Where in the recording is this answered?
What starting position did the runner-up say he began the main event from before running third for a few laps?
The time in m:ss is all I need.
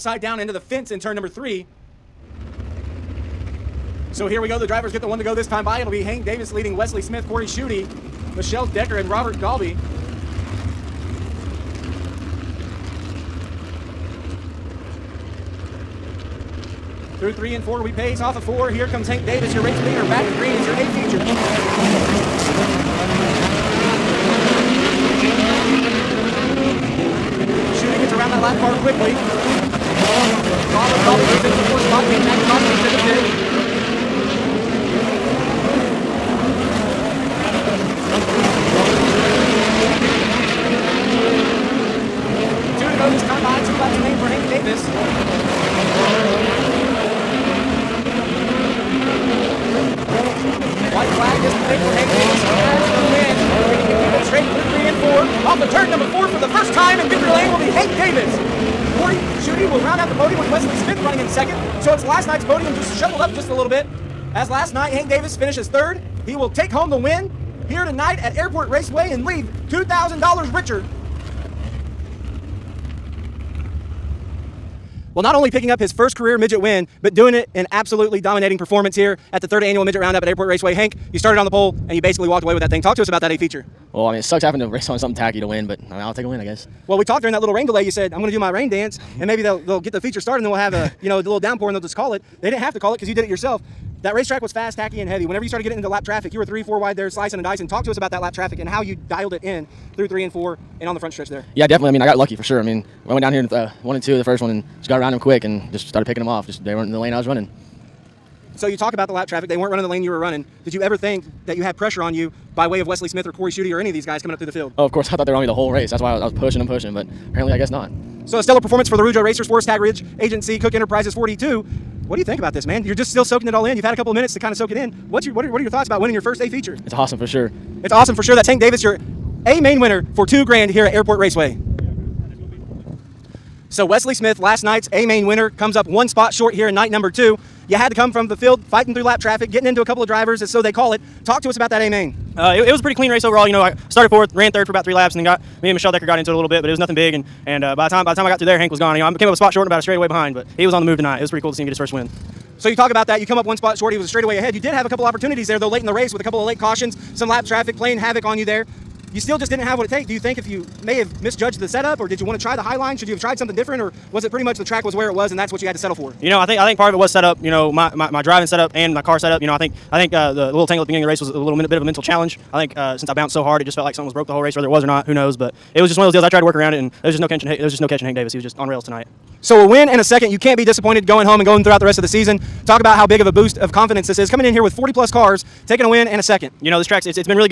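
2:23.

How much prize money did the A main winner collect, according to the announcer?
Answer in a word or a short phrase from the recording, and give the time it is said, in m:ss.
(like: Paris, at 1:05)
two grand, at 2:10.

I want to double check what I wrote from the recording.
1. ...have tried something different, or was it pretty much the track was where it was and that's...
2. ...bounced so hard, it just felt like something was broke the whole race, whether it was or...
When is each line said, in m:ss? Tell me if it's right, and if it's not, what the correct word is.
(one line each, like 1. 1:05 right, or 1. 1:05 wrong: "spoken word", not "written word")
1. 2:43 right
2. 2:53 right.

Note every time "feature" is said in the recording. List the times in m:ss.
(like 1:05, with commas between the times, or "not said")
0:22, 1:23, 1:29, 2:06.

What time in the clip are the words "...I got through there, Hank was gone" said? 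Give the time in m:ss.
2:28.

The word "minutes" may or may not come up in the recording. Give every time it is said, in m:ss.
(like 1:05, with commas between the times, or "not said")
2:04, 2:51.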